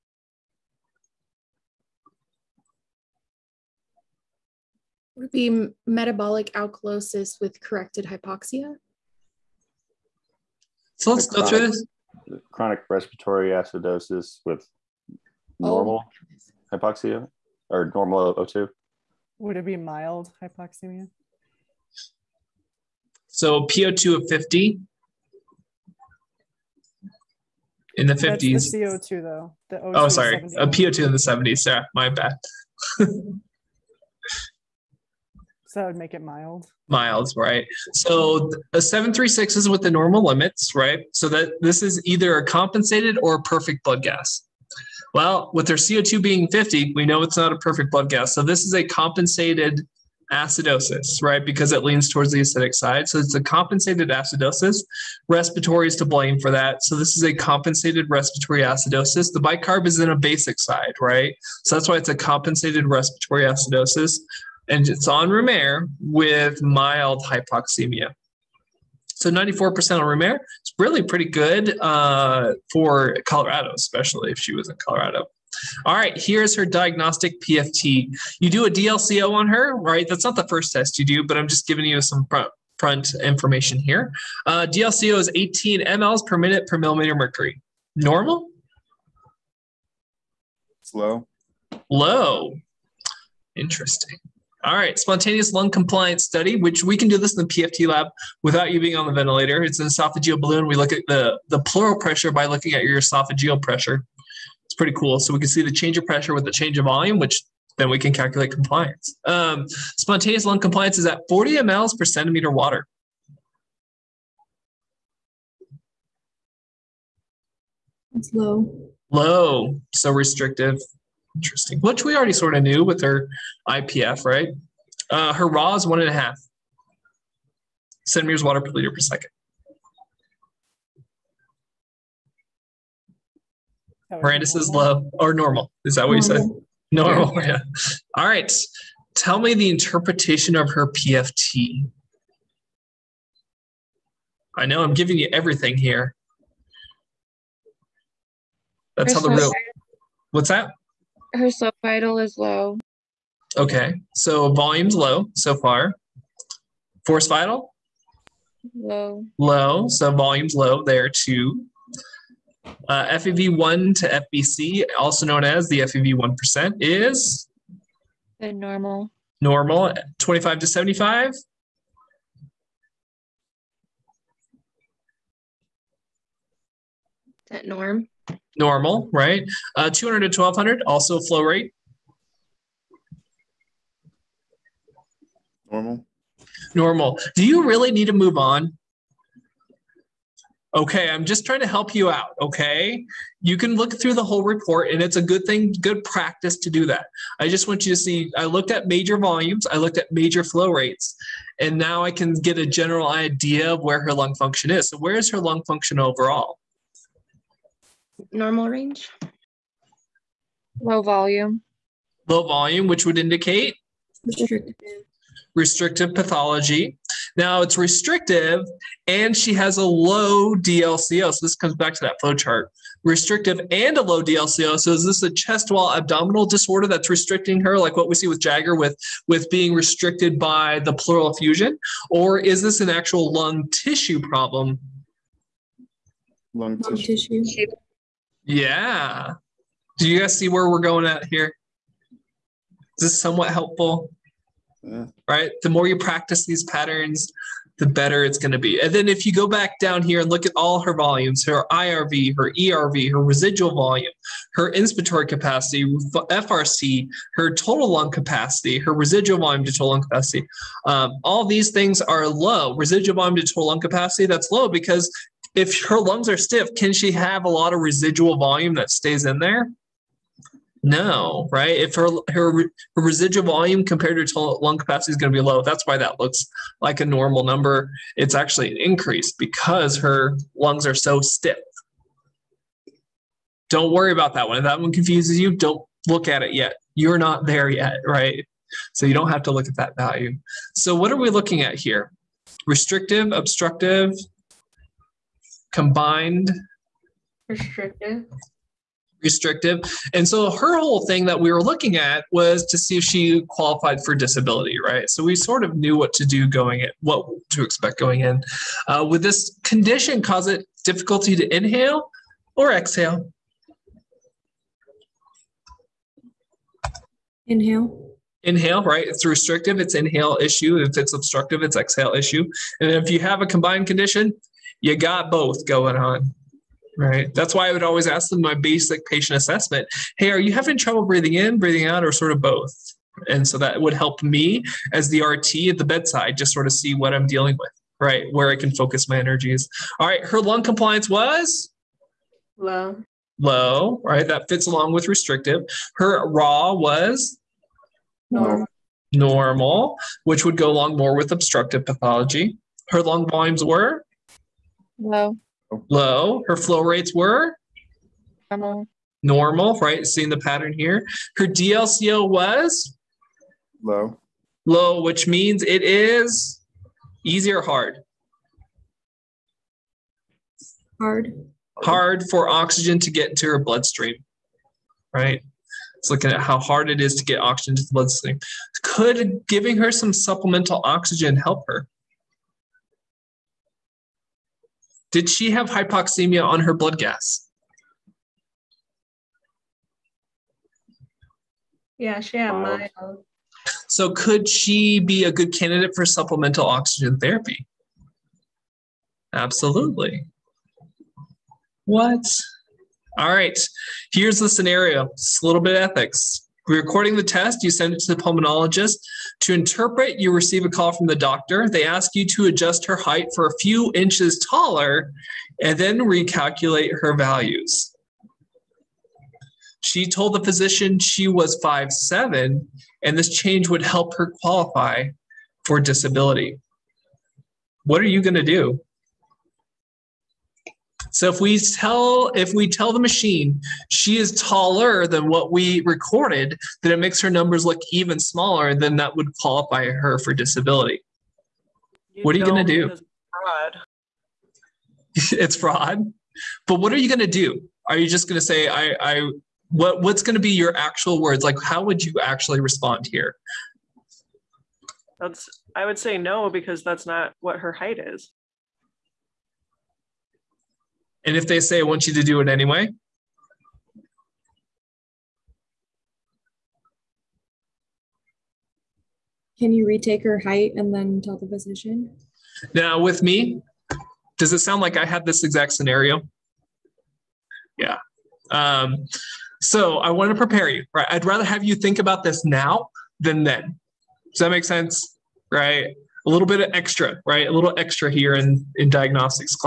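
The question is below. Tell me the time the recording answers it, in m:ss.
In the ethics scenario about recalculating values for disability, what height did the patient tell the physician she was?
7:01.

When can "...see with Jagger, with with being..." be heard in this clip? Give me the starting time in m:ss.
3:48.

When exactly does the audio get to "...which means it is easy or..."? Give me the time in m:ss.
6:05.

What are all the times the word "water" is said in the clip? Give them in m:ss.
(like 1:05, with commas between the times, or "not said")
1:52, 2:08.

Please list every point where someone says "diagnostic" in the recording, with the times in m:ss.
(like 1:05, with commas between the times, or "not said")
1:16, 8:08.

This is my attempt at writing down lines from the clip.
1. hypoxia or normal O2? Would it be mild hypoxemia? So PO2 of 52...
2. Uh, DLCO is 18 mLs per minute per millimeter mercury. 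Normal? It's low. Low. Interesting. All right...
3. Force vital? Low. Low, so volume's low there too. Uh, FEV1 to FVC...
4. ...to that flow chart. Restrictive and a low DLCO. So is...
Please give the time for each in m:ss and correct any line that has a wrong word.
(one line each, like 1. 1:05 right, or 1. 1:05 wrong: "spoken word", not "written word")
1. 0:16 wrong: "50", not "52"
2. 1:24 right
3. 2:37 right
4. 3:41 right.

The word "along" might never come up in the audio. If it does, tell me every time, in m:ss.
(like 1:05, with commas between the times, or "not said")
5:44, 5:50.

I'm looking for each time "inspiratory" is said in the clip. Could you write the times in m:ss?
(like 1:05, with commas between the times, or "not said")
4:14.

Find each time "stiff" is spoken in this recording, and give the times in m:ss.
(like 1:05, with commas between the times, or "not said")
4:26, 4:41.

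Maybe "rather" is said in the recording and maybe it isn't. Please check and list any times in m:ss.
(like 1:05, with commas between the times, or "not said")
8:01.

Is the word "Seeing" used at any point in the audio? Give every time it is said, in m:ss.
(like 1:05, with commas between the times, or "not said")
6:00.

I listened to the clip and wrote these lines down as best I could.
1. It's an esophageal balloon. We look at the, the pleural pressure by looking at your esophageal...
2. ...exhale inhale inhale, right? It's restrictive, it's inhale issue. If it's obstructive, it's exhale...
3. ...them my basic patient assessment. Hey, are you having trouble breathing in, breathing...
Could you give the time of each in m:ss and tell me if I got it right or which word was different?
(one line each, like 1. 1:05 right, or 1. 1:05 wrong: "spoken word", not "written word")
1. 1:39 right
2. 5:12 right
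3. 5:28 right.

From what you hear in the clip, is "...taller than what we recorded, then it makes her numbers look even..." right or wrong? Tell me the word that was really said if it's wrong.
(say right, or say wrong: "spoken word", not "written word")
right.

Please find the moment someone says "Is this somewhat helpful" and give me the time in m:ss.
4:02.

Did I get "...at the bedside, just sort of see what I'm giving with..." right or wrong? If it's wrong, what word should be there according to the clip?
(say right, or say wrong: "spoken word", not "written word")
wrong: "dealing", not "giving".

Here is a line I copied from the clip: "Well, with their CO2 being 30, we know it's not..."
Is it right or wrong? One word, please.
wrong.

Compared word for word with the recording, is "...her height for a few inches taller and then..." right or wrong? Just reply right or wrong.
right.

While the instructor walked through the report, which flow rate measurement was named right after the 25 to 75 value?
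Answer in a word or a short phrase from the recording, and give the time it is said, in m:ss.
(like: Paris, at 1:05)
200 to 1200, at 2:59.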